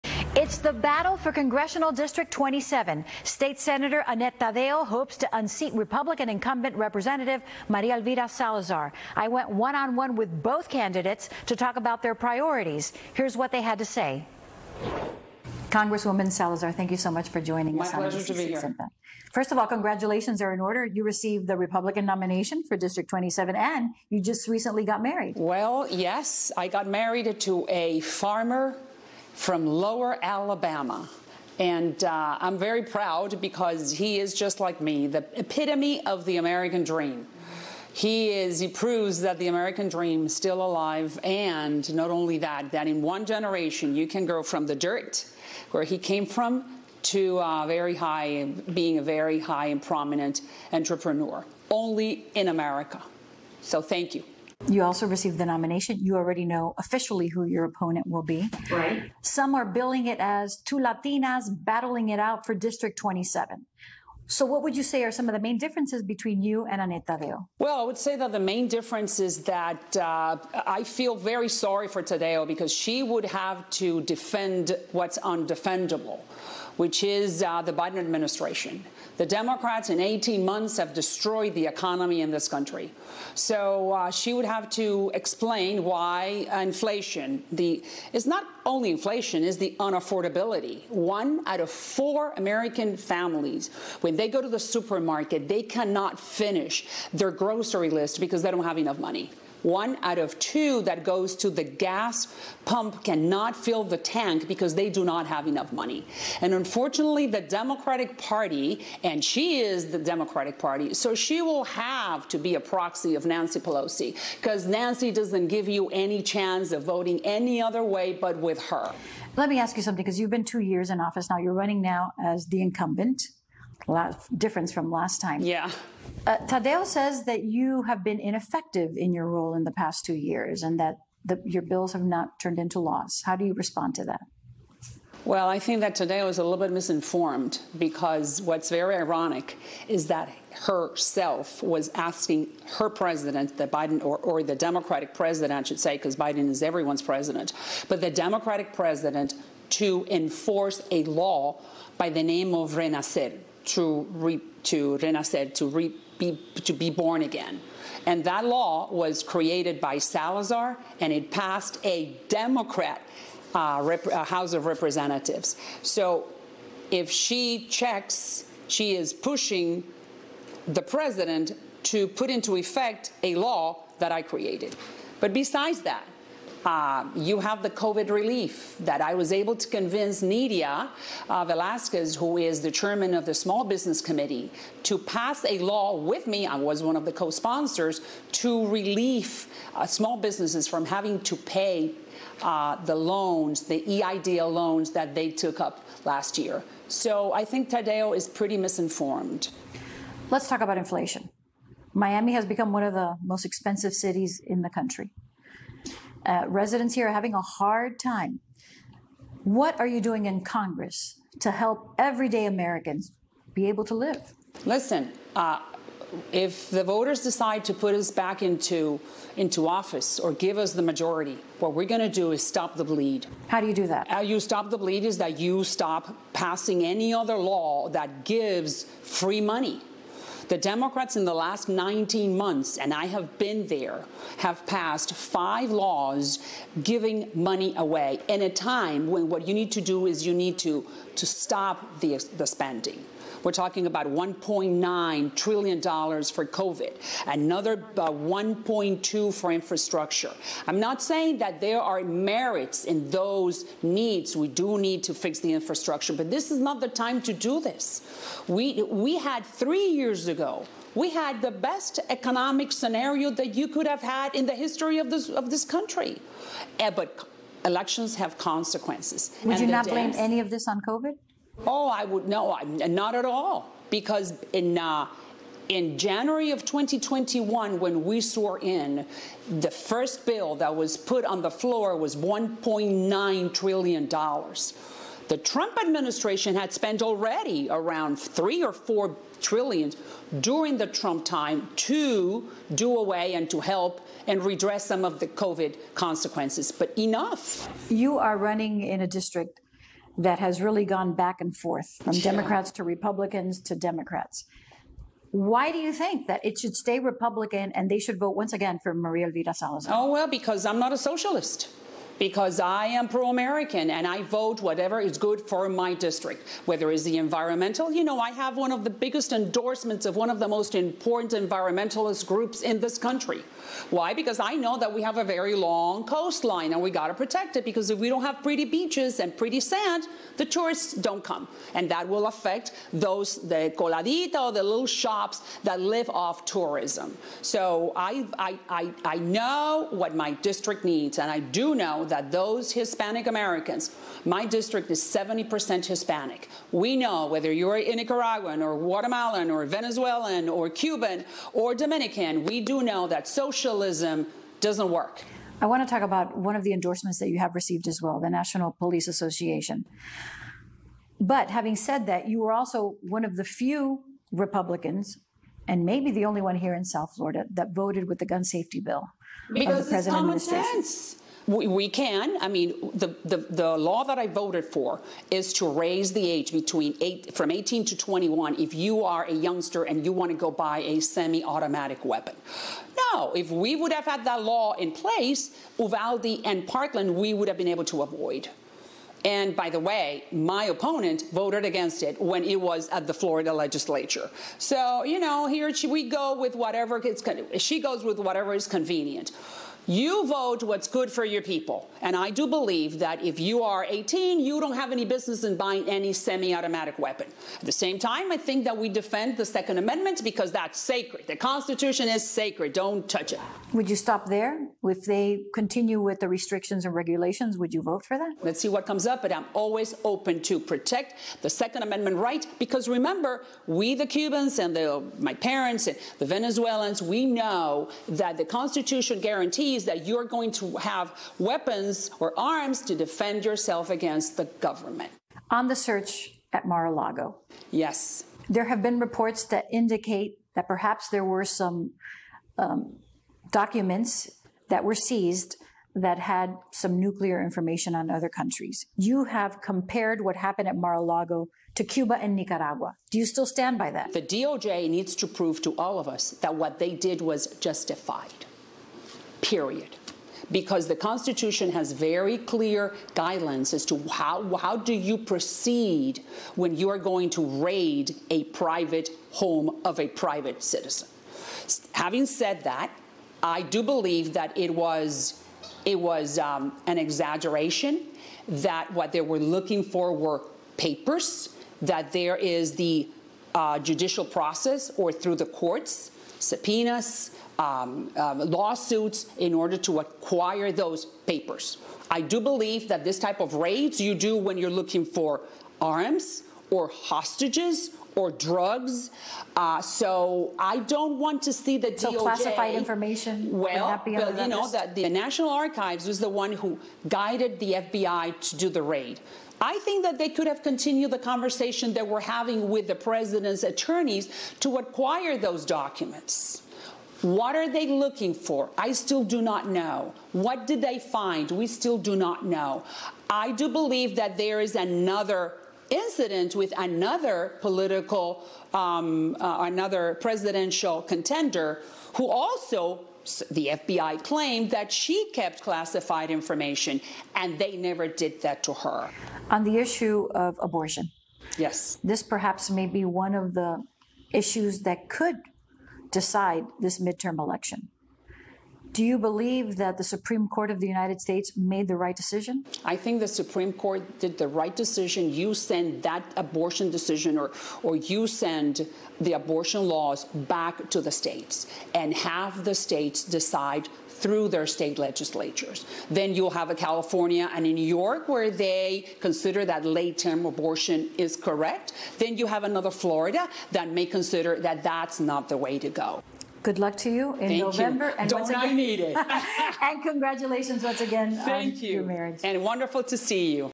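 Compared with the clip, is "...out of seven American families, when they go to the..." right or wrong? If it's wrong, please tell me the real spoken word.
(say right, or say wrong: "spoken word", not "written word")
wrong: "four", not "seven".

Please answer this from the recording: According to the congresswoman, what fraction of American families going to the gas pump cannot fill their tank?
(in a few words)
One out of two.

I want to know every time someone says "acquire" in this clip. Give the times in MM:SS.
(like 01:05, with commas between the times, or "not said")
08:09, 08:34.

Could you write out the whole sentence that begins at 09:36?
Good luck to you in Thank November.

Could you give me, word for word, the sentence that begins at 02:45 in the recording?
So if she checks, she is pushing the president to put into effect a law that I created.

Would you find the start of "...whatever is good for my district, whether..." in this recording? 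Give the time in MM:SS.
05:14.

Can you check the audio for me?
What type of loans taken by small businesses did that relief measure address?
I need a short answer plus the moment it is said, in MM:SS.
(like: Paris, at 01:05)
EIDL loans, at 03:13.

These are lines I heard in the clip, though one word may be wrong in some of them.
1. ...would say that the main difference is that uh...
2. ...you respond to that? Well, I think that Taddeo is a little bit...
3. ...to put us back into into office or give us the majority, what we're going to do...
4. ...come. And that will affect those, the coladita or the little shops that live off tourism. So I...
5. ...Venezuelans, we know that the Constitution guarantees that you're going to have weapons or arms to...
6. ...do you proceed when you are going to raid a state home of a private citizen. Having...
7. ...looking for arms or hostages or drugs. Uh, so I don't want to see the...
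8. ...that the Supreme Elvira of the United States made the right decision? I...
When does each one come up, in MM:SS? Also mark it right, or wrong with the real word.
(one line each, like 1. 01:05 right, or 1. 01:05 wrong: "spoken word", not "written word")
1. 01:07 right
2. 02:13 right
3. 03:37 right
4. 05:31 right
5. 07:06 right
6. 07:44 wrong: "private", not "state"
7. 08:14 right
8. 09:09 wrong: "Court", not "Elvira".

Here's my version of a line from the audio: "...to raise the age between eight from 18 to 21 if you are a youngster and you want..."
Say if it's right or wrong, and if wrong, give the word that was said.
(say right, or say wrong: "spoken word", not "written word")
right.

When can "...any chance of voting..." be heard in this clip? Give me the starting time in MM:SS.
01:55.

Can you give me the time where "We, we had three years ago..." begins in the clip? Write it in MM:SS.
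04:18.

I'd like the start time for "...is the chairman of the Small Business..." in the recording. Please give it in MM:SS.
03:02.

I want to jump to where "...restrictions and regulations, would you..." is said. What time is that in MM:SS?
06:56.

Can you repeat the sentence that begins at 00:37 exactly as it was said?
He is, he proves that the American dream is still alive.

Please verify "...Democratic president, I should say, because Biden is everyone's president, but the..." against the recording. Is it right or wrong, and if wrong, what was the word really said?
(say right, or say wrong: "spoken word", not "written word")
right.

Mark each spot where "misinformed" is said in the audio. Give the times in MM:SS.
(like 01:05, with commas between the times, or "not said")
02:16, 03:18.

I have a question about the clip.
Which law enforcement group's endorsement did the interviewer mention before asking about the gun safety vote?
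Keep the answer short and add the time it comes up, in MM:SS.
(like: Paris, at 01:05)
National Police Association, at 05:58.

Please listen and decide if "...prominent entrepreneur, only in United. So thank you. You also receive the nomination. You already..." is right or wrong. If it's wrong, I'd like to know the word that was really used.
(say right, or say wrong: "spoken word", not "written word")
wrong: "America", not "United".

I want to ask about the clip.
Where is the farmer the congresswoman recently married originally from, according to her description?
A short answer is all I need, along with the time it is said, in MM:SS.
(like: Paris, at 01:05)
Lower Alabama, at 00:29.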